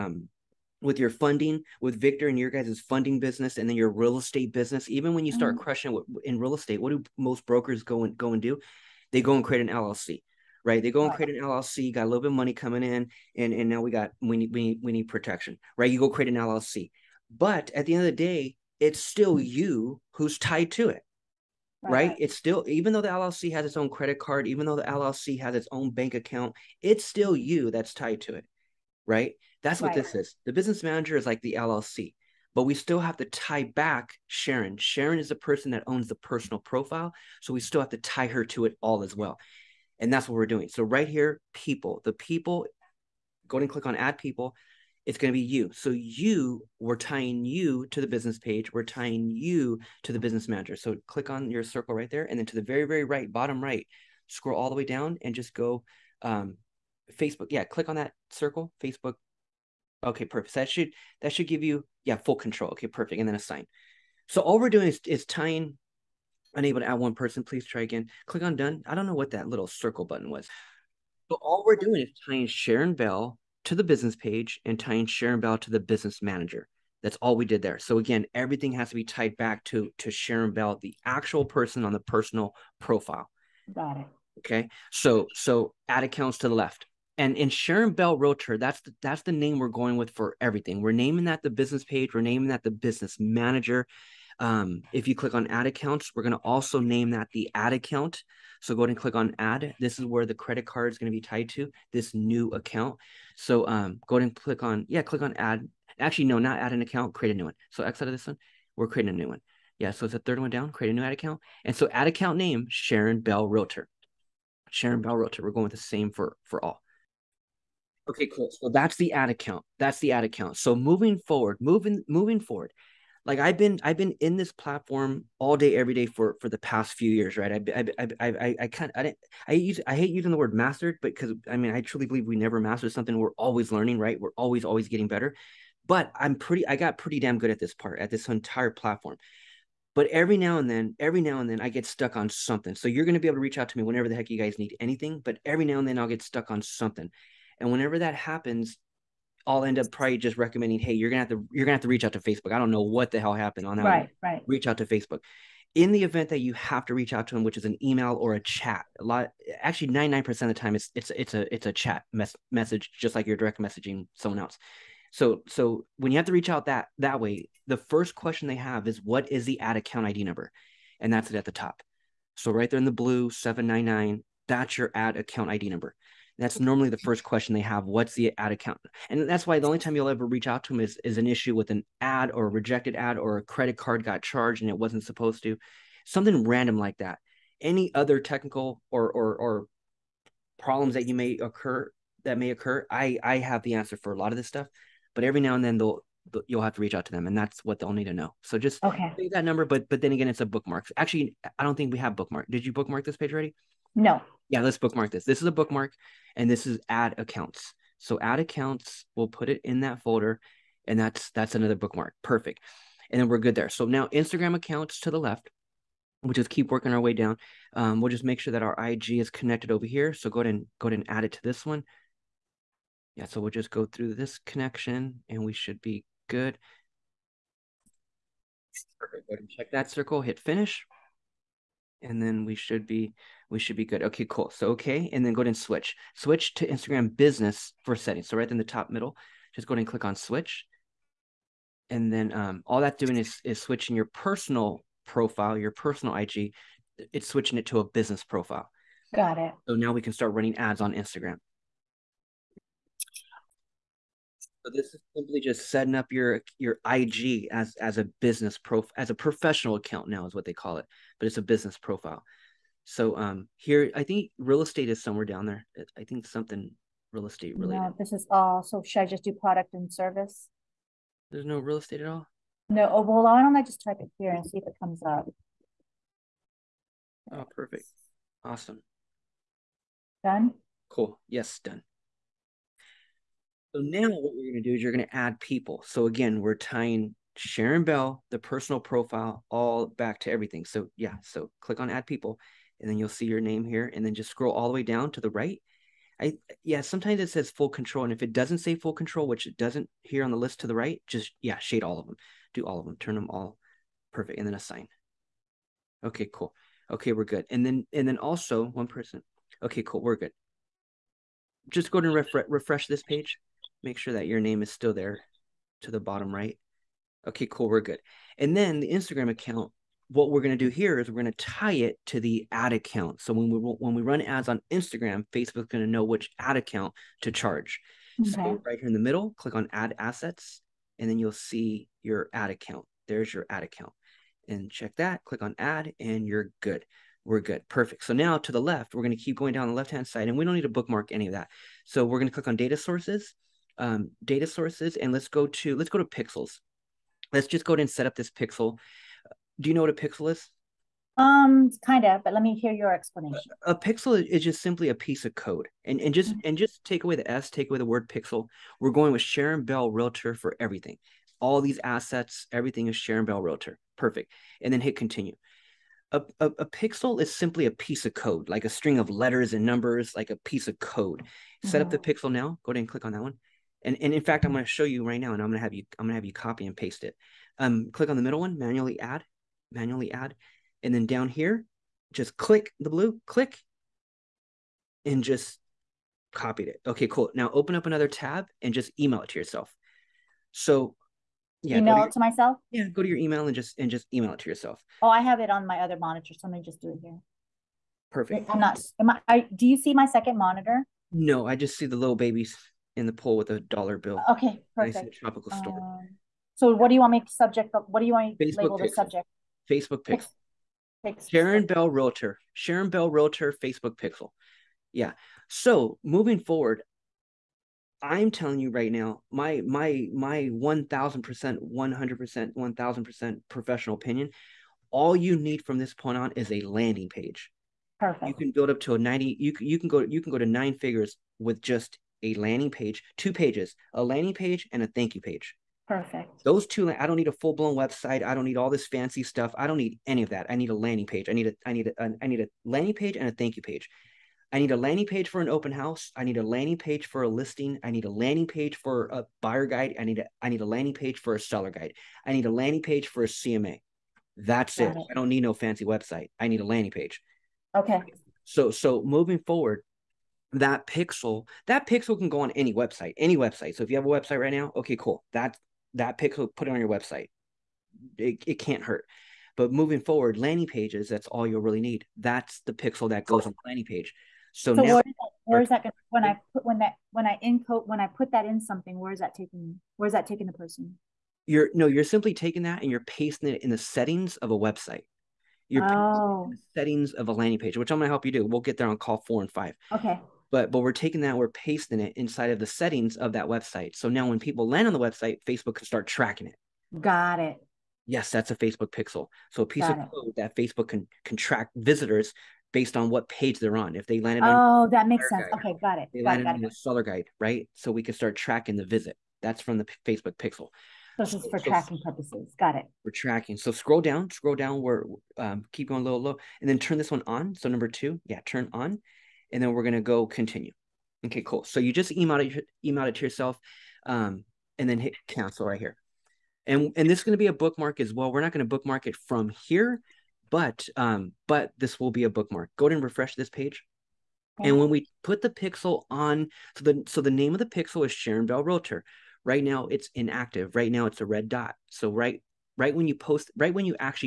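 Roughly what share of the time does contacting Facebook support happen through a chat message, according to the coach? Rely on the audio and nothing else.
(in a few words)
99%.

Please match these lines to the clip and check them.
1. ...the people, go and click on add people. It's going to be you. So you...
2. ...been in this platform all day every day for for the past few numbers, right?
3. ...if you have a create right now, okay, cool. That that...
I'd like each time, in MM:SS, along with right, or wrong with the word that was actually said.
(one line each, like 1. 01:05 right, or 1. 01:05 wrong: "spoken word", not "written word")
1. 00:42 right
2. 02:03 wrong: "years", not "numbers"
3. 07:43 wrong: "website", not "create".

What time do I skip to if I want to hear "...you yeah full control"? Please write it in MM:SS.
01:01.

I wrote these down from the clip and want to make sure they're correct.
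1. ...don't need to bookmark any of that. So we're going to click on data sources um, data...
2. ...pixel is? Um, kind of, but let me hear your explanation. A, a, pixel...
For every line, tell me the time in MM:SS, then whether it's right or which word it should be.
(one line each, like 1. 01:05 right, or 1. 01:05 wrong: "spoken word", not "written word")
1. 05:40 right
2. 05:49 right.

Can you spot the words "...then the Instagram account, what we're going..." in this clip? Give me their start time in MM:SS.
05:18.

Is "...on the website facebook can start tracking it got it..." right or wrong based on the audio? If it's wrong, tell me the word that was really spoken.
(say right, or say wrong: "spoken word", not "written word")
right.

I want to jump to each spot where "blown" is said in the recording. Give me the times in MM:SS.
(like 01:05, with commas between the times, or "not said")
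07:17.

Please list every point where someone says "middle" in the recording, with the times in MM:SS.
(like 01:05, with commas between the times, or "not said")
03:58, 05:28, 06:18.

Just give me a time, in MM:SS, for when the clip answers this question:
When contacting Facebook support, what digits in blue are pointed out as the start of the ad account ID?
02:53.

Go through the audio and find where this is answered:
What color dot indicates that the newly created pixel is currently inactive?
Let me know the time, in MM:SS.
09:01.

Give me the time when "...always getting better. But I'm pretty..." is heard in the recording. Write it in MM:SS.
02:14.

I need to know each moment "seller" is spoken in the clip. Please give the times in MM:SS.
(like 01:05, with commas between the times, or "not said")
07:31, 08:26.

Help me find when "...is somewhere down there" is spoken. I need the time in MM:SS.
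04:24.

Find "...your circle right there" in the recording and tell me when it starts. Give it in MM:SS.
00:51.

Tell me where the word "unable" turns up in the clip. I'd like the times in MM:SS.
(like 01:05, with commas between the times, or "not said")
01:06.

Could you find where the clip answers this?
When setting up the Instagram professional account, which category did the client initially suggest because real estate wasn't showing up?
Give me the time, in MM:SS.
04:29.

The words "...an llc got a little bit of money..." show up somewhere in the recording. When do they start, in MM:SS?
00:11.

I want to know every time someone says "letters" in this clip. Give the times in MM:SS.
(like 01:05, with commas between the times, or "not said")
06:09.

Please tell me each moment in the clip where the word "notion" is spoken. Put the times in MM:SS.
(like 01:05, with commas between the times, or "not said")
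not said.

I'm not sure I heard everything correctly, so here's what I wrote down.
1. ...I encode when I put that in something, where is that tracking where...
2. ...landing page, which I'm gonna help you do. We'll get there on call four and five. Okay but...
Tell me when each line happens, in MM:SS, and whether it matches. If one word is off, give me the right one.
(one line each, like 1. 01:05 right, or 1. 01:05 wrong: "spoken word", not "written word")
1. 07:57 wrong: "taking", not "tracking"
2. 08:07 right.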